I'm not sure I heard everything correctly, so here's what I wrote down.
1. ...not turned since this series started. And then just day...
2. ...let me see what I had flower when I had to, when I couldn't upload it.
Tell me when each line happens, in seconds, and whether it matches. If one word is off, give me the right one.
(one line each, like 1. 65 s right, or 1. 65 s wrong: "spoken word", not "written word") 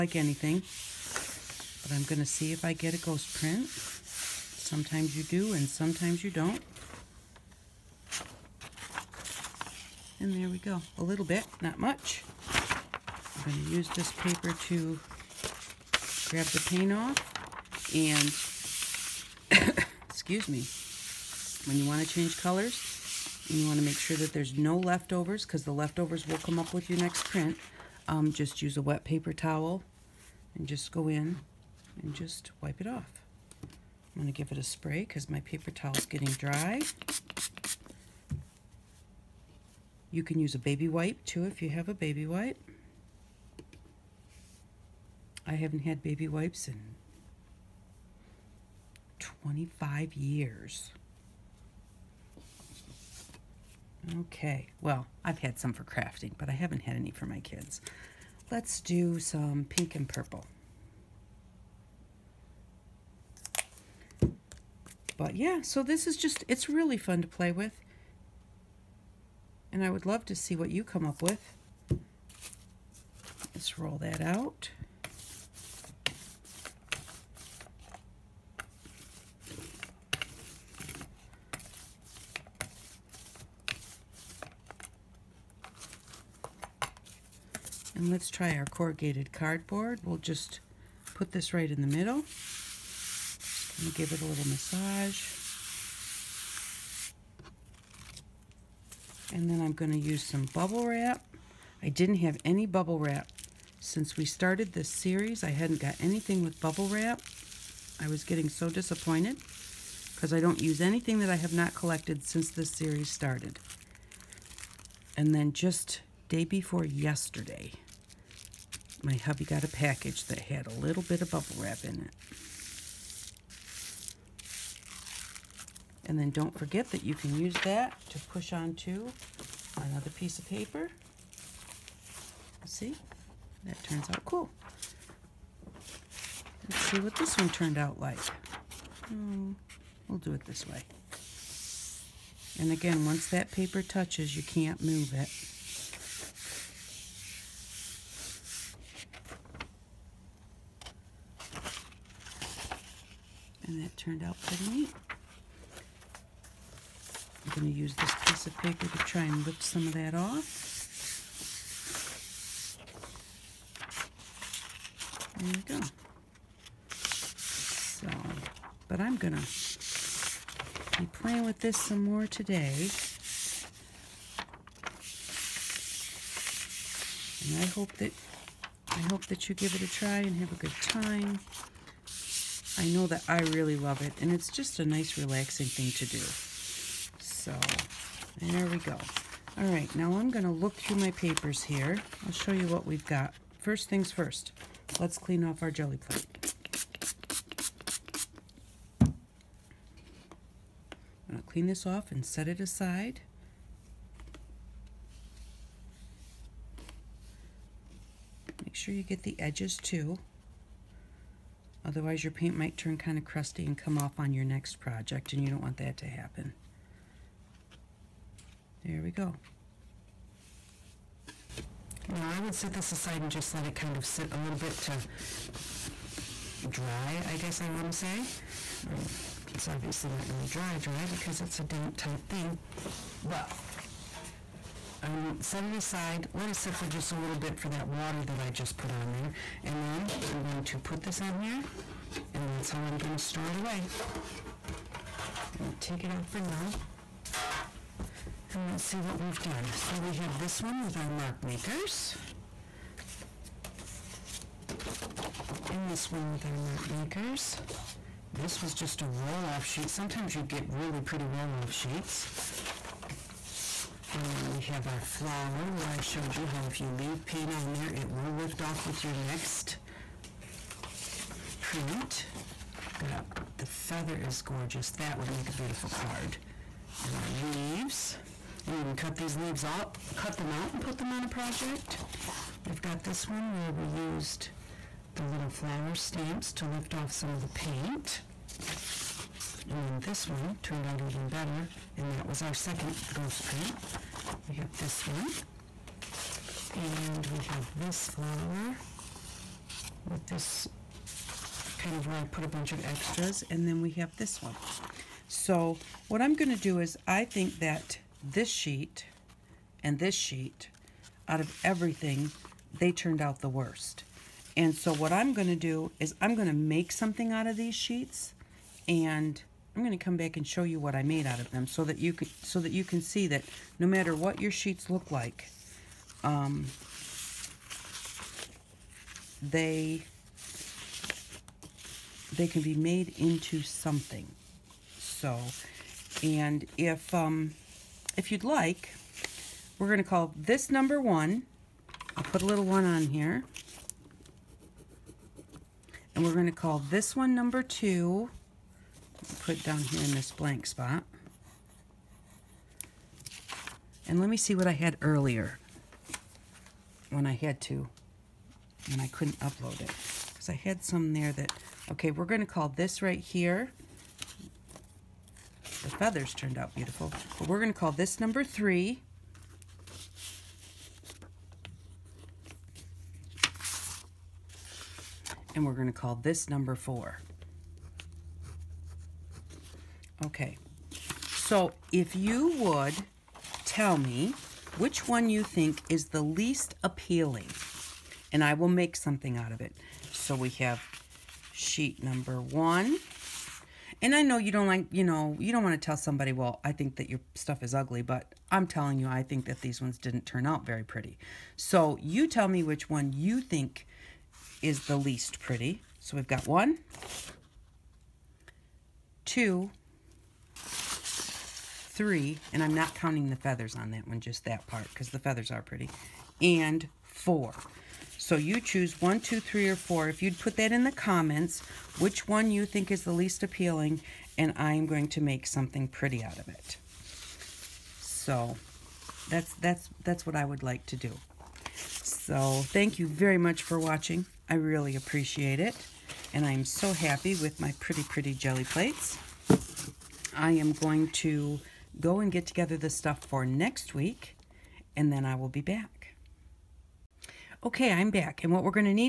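1. 111 s wrong: "collected", not "turned"
2. 354 s wrong: "earlier", not "flower".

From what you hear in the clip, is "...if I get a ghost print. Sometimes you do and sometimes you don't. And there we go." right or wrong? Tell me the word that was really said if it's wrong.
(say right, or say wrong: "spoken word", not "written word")
right.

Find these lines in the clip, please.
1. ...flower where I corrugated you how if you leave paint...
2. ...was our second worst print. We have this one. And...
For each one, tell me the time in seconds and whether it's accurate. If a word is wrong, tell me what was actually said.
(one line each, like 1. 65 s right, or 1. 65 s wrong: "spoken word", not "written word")
1. 264 s wrong: "showed", not "corrugated"
2. 292 s wrong: "ghost", not "worst".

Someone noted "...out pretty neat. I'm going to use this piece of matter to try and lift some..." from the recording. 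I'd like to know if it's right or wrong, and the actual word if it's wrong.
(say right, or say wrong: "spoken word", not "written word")
wrong: "paper", not "matter".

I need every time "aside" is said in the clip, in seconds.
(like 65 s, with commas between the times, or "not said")
202 s, 222 s, 235 s.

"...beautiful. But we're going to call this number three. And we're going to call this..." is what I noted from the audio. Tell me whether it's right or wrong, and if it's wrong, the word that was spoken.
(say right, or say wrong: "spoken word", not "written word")
right.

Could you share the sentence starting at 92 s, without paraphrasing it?
Just give it a little massage.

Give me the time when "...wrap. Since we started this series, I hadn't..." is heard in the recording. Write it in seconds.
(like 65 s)
102 s.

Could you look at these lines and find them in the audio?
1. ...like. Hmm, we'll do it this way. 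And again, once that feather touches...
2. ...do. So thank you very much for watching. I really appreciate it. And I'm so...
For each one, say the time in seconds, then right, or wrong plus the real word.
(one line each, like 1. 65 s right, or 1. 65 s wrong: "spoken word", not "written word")
1. 137 s wrong: "paper", not "feather"
2. 430 s right.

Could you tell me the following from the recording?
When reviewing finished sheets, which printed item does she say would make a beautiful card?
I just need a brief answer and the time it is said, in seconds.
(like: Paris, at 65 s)
the feather, at 273 s.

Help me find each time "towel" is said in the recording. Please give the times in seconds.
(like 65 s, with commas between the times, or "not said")
29 s, 35 s.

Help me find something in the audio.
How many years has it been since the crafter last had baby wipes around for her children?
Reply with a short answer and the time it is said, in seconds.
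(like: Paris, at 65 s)
25, at 49 s.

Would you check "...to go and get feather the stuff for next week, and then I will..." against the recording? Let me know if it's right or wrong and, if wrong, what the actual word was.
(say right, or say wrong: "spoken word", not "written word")
wrong: "together", not "feather".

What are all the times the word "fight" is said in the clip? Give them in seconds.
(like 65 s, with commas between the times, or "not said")
not said.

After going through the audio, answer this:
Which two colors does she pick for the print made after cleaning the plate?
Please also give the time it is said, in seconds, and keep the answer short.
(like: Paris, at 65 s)
pink and purple, at 59 s.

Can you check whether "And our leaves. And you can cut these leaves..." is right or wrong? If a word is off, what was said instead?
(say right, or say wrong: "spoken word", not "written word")
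right.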